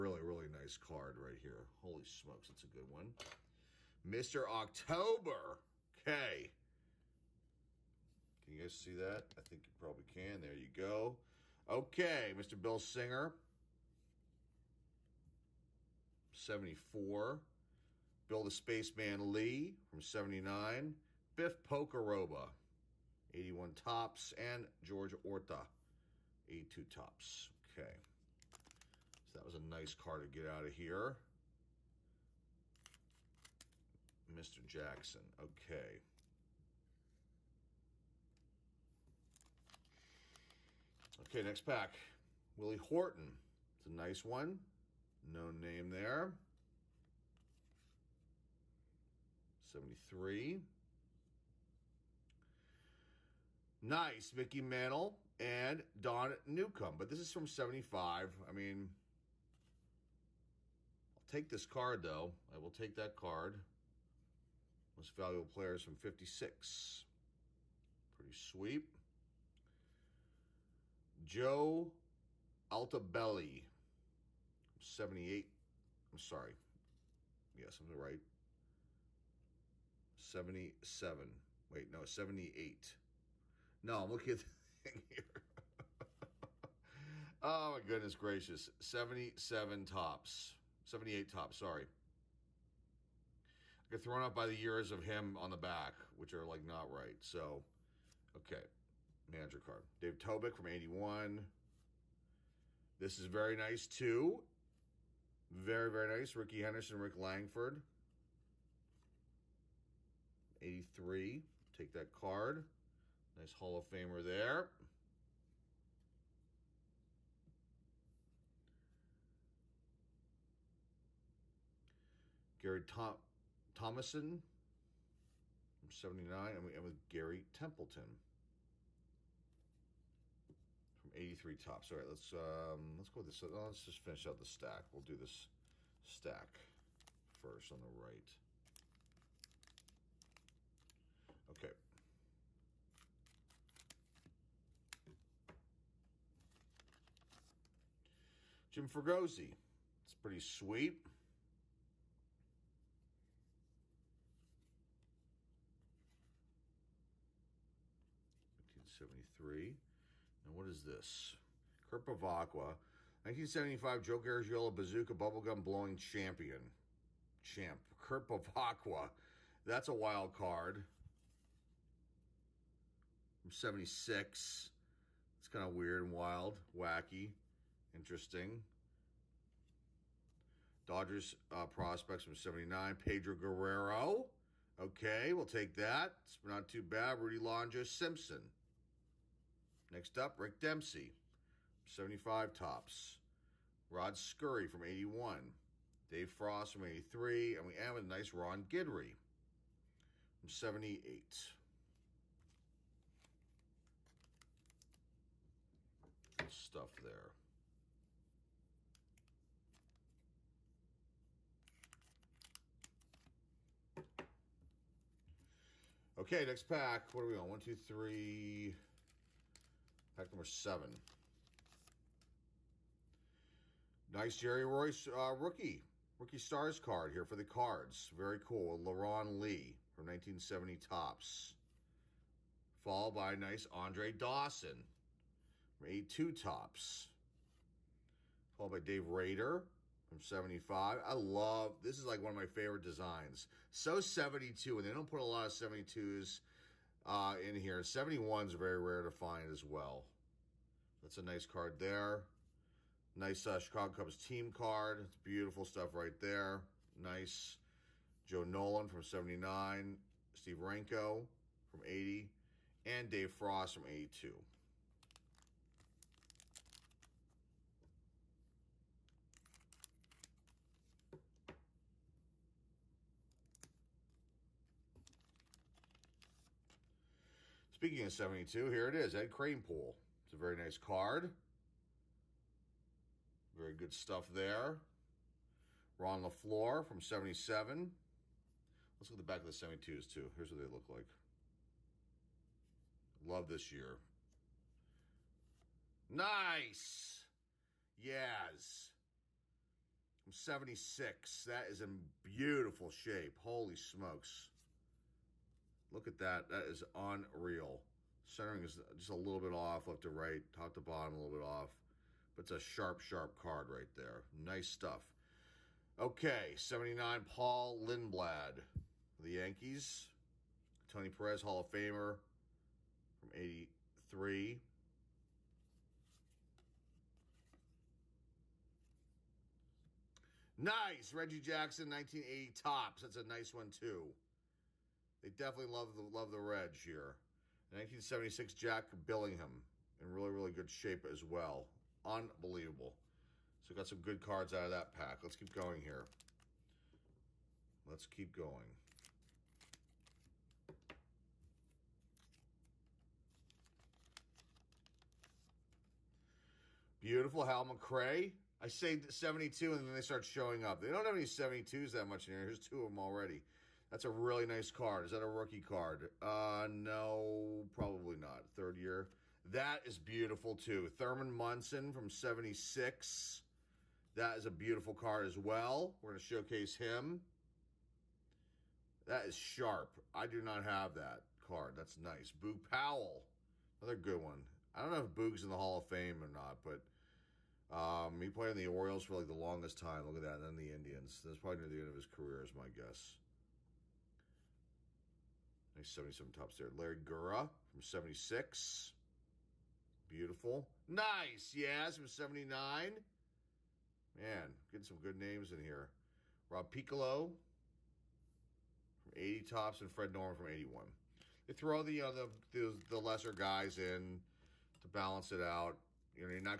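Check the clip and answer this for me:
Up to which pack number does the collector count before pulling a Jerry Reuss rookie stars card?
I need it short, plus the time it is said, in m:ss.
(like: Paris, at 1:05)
7, at 3:40.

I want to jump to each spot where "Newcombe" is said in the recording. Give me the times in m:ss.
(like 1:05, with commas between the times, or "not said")
0:56.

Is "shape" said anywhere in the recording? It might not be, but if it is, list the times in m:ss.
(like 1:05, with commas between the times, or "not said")
5:02, 5:40.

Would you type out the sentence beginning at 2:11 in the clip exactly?
All right, let's um, let's go with this.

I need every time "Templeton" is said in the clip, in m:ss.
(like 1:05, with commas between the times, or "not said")
2:07.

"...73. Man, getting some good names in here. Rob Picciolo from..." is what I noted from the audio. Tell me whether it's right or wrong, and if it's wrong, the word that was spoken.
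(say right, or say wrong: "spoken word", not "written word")
wrong: "79", not "73".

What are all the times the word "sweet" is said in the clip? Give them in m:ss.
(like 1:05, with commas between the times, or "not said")
1:08, 2:30.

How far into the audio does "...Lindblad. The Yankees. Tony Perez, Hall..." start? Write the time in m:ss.
5:17.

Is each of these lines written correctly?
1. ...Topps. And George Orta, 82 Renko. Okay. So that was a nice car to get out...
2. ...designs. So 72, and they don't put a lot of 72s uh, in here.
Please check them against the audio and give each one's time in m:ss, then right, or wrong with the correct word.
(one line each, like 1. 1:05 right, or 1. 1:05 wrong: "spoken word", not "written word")
1. 0:23 wrong: "Topps", not "Renko"
2. 4:02 right.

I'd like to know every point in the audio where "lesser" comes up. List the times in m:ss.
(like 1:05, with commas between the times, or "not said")
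6:52.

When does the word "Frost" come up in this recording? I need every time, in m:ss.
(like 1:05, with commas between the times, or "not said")
3:16, 4:23.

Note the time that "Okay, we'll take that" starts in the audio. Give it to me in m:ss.
3:04.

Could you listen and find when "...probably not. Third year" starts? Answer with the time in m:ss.
6:07.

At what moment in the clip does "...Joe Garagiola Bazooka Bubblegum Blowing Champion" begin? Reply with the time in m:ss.
2:44.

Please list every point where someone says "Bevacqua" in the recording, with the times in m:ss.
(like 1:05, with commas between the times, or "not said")
2:42, 2:48.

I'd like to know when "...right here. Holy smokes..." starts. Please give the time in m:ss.
0:01.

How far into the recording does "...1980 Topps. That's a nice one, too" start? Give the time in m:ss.
5:31.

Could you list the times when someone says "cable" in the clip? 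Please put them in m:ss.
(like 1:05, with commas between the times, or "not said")
not said.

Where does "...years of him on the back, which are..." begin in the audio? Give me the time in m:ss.
1:34.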